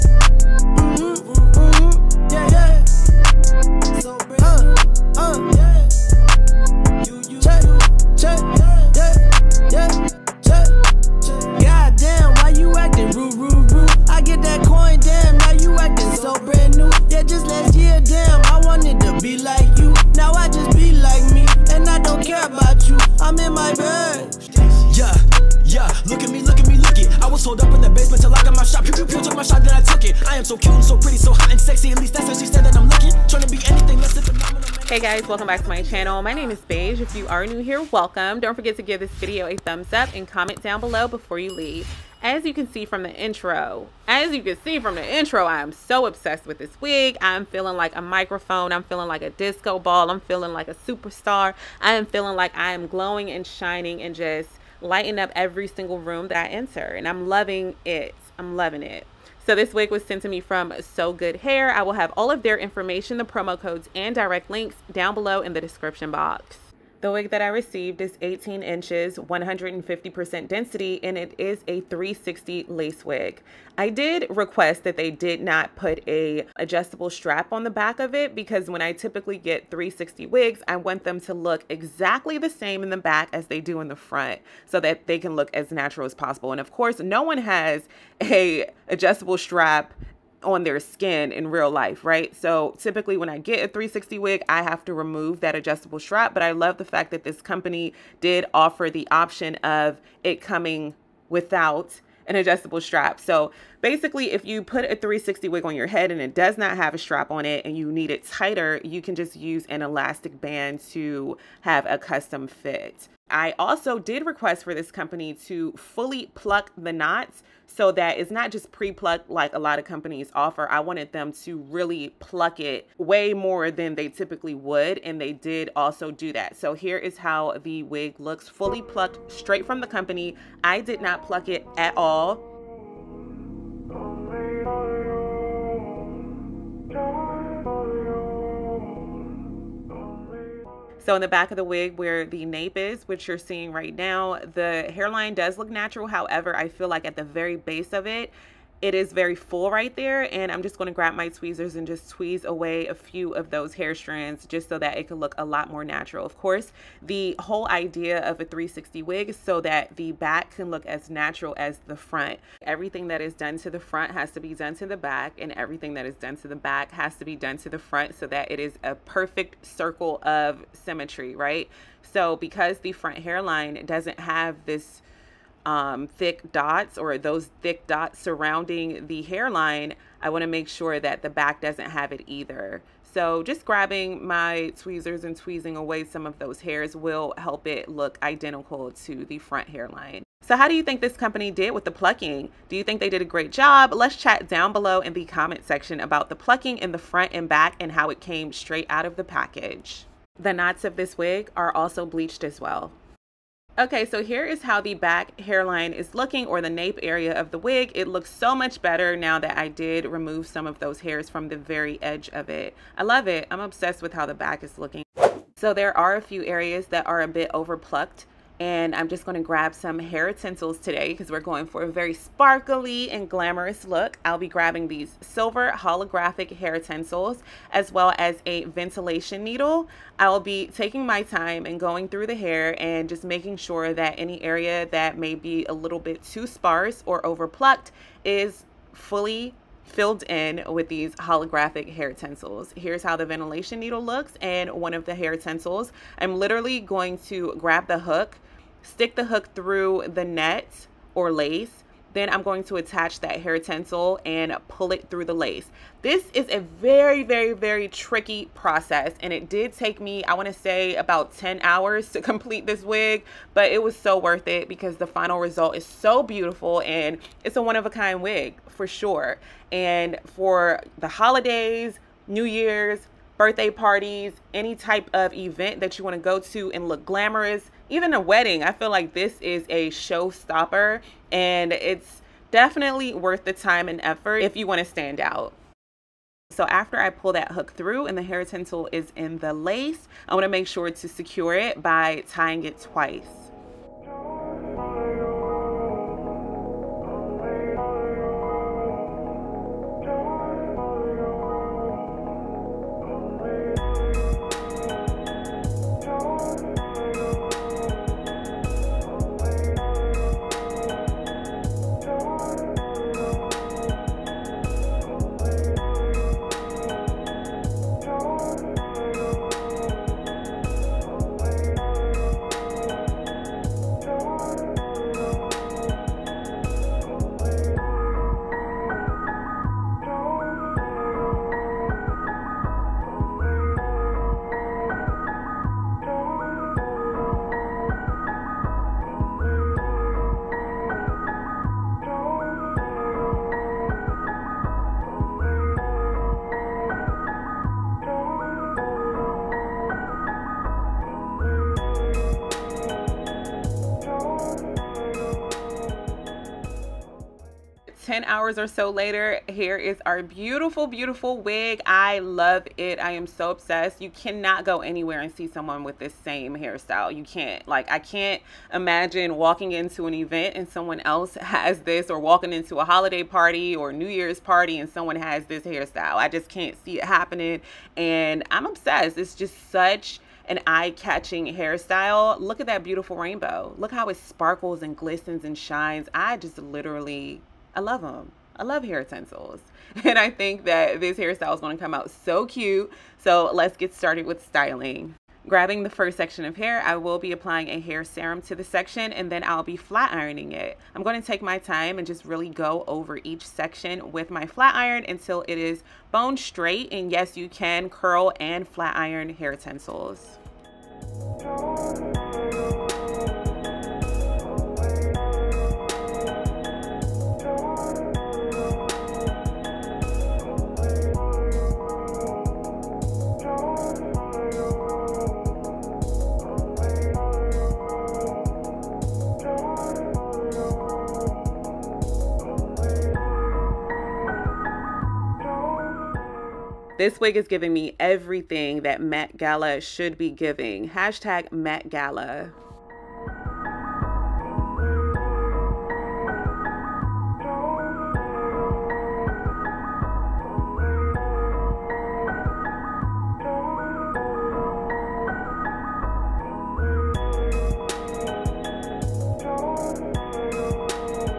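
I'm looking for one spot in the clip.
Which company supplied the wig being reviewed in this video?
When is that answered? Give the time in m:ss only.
1:00.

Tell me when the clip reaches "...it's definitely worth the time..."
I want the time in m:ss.
4:41.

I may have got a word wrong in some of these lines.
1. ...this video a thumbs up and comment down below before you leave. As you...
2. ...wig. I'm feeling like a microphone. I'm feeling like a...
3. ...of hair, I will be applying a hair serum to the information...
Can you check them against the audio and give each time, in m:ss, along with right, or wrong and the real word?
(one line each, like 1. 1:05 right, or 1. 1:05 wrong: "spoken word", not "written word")
1. 0:39 right
2. 0:46 right
3. 6:36 wrong: "section", not "information".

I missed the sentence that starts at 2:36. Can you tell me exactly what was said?
Of course, the whole idea of a 360 wig is so that the back can look as natural as the front.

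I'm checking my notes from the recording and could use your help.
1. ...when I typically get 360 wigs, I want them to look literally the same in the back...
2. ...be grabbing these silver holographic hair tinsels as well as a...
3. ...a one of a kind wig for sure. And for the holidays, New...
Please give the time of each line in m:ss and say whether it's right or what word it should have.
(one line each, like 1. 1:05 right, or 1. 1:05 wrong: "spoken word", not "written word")
1. 1:18 wrong: "exactly", not "literally"
2. 3:44 right
3. 4:27 right.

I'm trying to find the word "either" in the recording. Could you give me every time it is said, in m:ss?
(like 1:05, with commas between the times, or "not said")
3:02.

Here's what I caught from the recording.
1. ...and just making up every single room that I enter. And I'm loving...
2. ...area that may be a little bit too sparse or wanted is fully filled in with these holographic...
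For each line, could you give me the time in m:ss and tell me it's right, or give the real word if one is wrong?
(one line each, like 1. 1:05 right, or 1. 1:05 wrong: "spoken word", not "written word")
1. 0:54 wrong: "lighting", not "making"
2. 3:54 wrong: "overplucked", not "wanted".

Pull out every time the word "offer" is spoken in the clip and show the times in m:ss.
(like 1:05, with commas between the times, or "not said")
1:38, 2:00.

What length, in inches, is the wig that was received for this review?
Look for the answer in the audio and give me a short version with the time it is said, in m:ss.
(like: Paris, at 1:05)
18 inches, at 1:08.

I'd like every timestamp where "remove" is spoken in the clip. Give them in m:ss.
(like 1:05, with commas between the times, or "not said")
1:34, 3:30.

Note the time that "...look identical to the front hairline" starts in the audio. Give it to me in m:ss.
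3:07.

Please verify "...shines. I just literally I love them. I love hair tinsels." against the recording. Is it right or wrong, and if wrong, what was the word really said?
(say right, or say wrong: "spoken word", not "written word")
right.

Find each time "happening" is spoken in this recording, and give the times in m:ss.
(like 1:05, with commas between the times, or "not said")
6:17.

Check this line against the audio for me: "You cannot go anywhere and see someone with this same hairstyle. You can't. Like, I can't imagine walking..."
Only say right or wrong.
right.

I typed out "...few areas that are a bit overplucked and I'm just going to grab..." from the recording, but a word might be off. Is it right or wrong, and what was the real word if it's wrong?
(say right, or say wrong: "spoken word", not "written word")
right.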